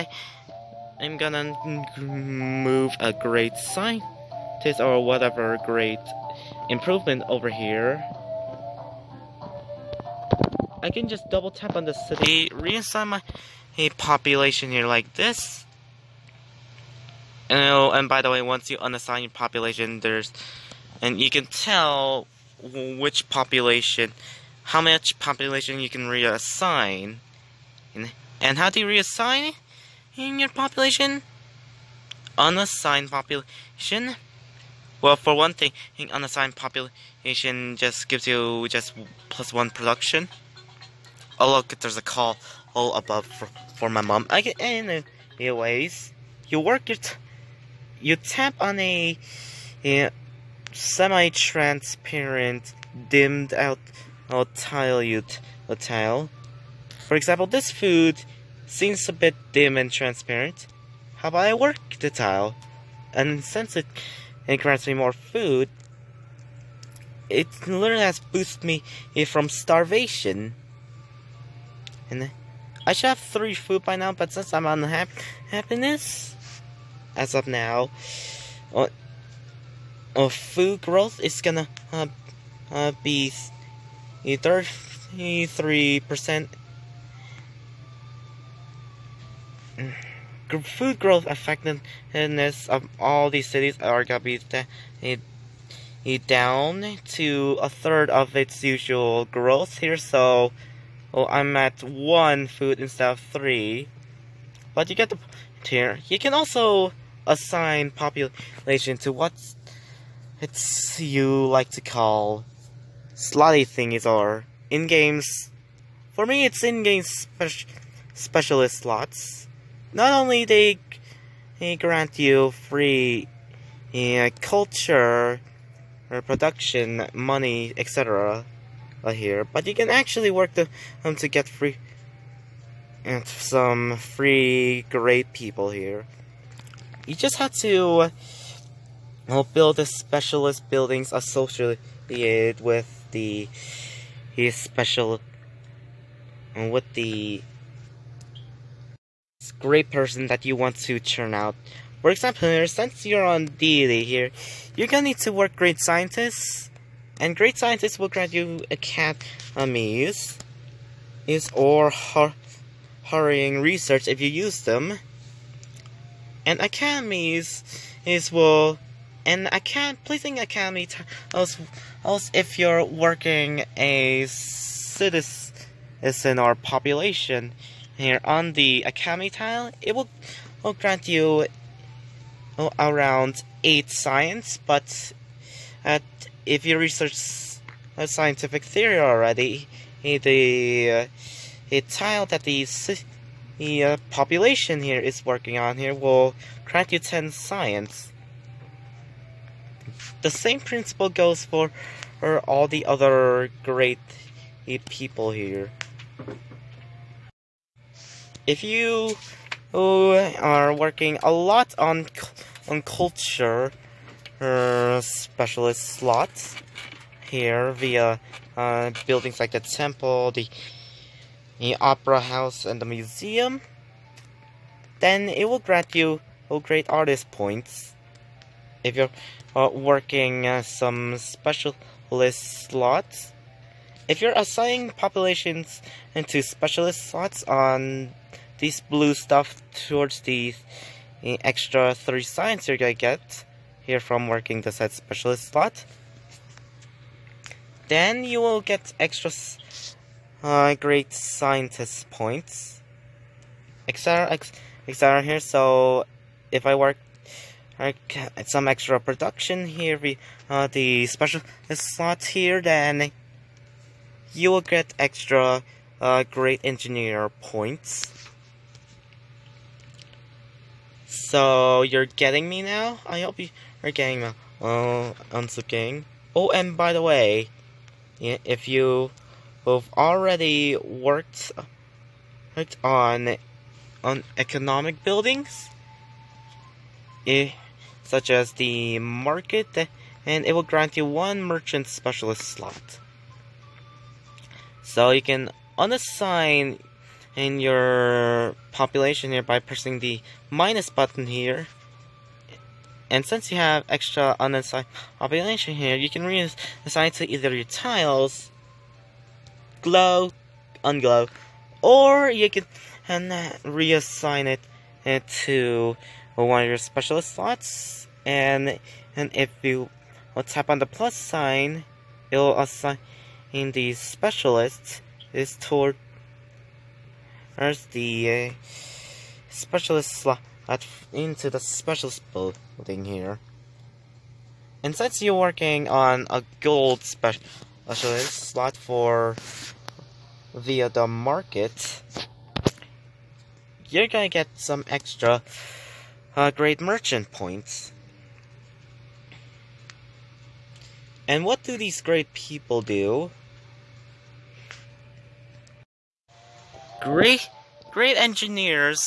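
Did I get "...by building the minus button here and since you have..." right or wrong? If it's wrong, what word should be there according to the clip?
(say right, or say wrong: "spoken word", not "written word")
wrong: "pressing", not "building".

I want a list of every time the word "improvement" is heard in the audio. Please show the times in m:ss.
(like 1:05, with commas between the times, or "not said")
0:06.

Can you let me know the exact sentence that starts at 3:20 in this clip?
The same principle goes for, for all the other great uh, people here.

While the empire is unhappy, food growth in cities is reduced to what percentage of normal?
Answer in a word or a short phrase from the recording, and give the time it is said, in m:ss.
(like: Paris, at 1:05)
33%, at 1:24.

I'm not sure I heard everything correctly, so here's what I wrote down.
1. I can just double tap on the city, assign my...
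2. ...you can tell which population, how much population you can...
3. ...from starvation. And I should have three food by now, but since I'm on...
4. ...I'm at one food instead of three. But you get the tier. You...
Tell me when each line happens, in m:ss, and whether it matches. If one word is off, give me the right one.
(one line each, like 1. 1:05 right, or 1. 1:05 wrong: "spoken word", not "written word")
1. 0:10 wrong: "reassign", not "assign"
2. 0:21 right
3. 1:09 right
4. 1:41 right.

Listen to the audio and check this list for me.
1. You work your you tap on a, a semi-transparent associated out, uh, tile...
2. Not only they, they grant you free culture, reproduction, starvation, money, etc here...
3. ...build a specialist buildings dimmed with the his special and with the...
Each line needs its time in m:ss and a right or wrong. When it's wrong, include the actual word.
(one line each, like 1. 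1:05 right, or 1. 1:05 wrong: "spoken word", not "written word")
1. 0:46 wrong: "dimmed", not "associated"
2. 1:59 wrong: "production", not "starvation"
3. 2:19 wrong: "associated", not "dimmed".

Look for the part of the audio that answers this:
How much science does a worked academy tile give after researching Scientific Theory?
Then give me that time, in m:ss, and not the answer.
3:17.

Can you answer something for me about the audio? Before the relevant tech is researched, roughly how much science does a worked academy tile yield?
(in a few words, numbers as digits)
8.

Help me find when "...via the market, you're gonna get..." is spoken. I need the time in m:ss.
5:40.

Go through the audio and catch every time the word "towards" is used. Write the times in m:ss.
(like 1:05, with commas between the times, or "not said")
3:59, 5:25.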